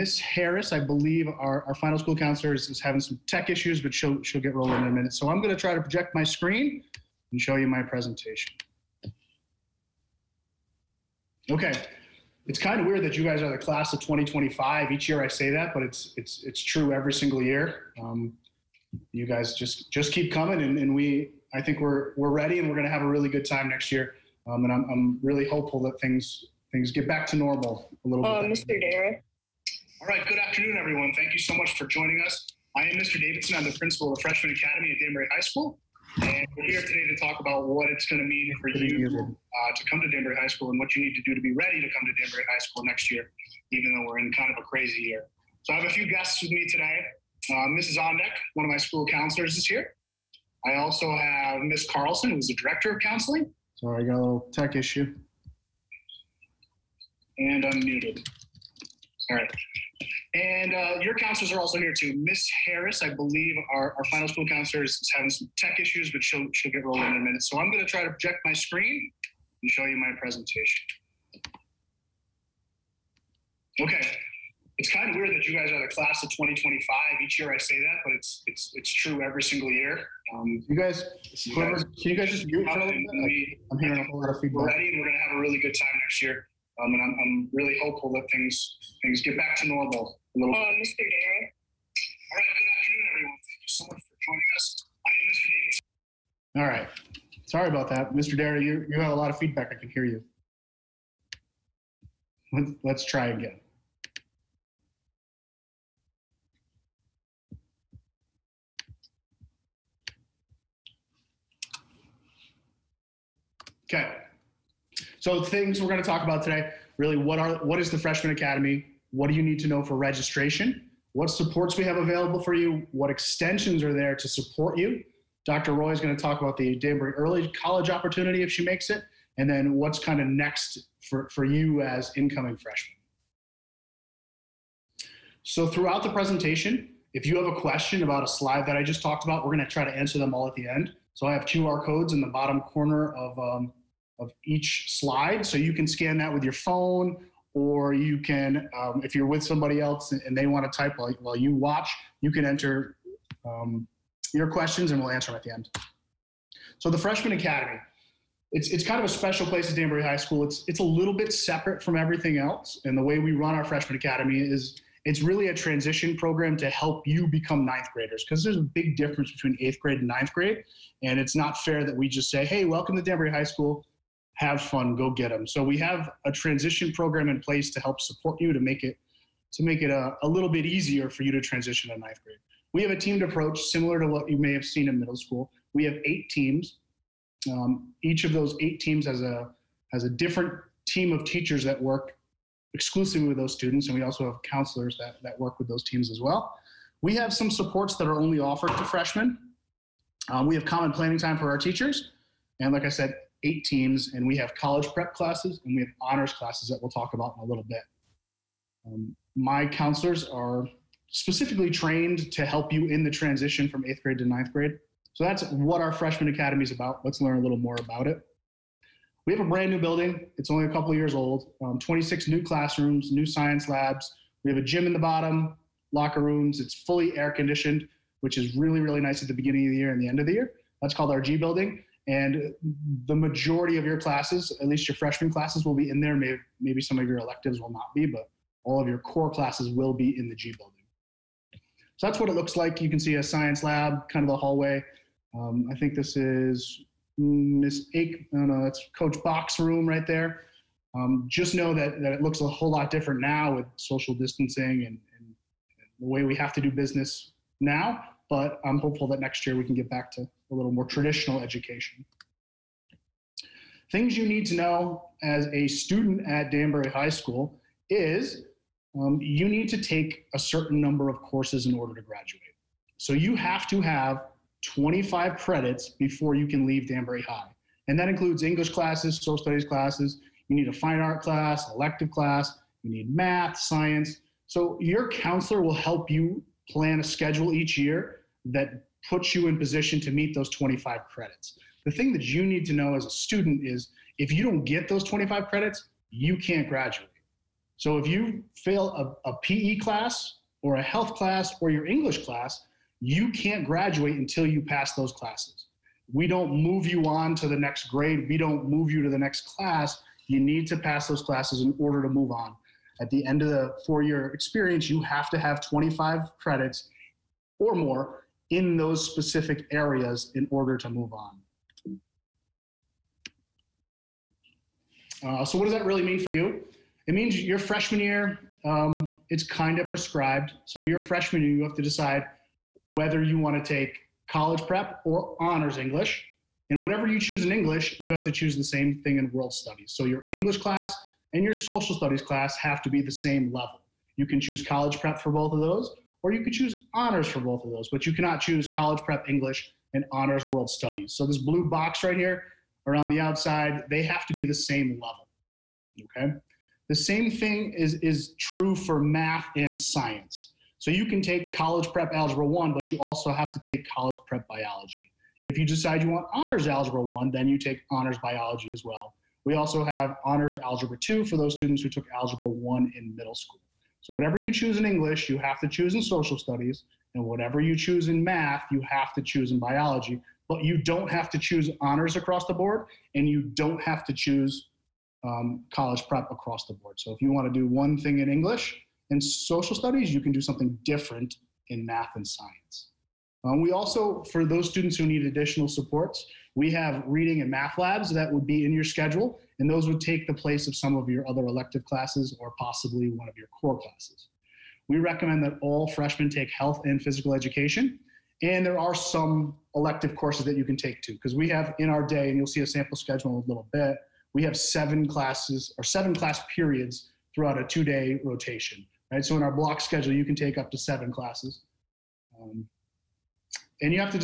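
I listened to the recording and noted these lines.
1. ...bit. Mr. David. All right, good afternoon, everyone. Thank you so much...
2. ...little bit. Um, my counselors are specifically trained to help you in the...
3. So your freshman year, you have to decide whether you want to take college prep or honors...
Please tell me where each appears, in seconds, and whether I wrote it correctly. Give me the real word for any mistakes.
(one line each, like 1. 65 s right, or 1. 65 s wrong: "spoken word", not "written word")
1. 90 s right
2. 207 s right
3. 330 s right.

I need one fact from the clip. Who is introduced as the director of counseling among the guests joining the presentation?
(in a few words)
Miss Carlson.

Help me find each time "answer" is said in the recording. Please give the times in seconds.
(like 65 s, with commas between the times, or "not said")
139 s, 155 s.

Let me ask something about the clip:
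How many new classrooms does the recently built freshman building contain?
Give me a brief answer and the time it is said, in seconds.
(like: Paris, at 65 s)
26, at 221 s.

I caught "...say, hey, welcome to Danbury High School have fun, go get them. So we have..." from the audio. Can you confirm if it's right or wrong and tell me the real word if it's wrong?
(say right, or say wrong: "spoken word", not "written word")
right.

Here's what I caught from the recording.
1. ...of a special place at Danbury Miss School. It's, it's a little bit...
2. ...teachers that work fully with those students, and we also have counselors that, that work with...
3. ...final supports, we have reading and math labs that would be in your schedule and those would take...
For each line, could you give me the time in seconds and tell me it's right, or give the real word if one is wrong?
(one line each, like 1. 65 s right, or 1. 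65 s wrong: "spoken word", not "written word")
1. 158 s wrong: "High", not "Miss"
2. 191 s wrong: "exclusively", not "fully"
3. 395 s wrong: "additional", not "final".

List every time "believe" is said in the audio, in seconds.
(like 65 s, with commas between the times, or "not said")
0 s, 63 s.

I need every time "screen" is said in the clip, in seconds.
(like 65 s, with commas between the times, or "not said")
6 s, 68 s.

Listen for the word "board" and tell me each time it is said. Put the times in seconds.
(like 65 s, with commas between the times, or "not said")
382 s, 386 s.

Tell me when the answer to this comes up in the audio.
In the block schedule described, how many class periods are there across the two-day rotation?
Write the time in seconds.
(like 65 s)
415 s.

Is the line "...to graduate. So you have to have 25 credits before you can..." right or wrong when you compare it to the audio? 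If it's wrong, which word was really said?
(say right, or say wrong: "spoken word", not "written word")
right.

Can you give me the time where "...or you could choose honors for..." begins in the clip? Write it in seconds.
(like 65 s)
346 s.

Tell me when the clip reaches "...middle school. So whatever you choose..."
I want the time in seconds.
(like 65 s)
373 s.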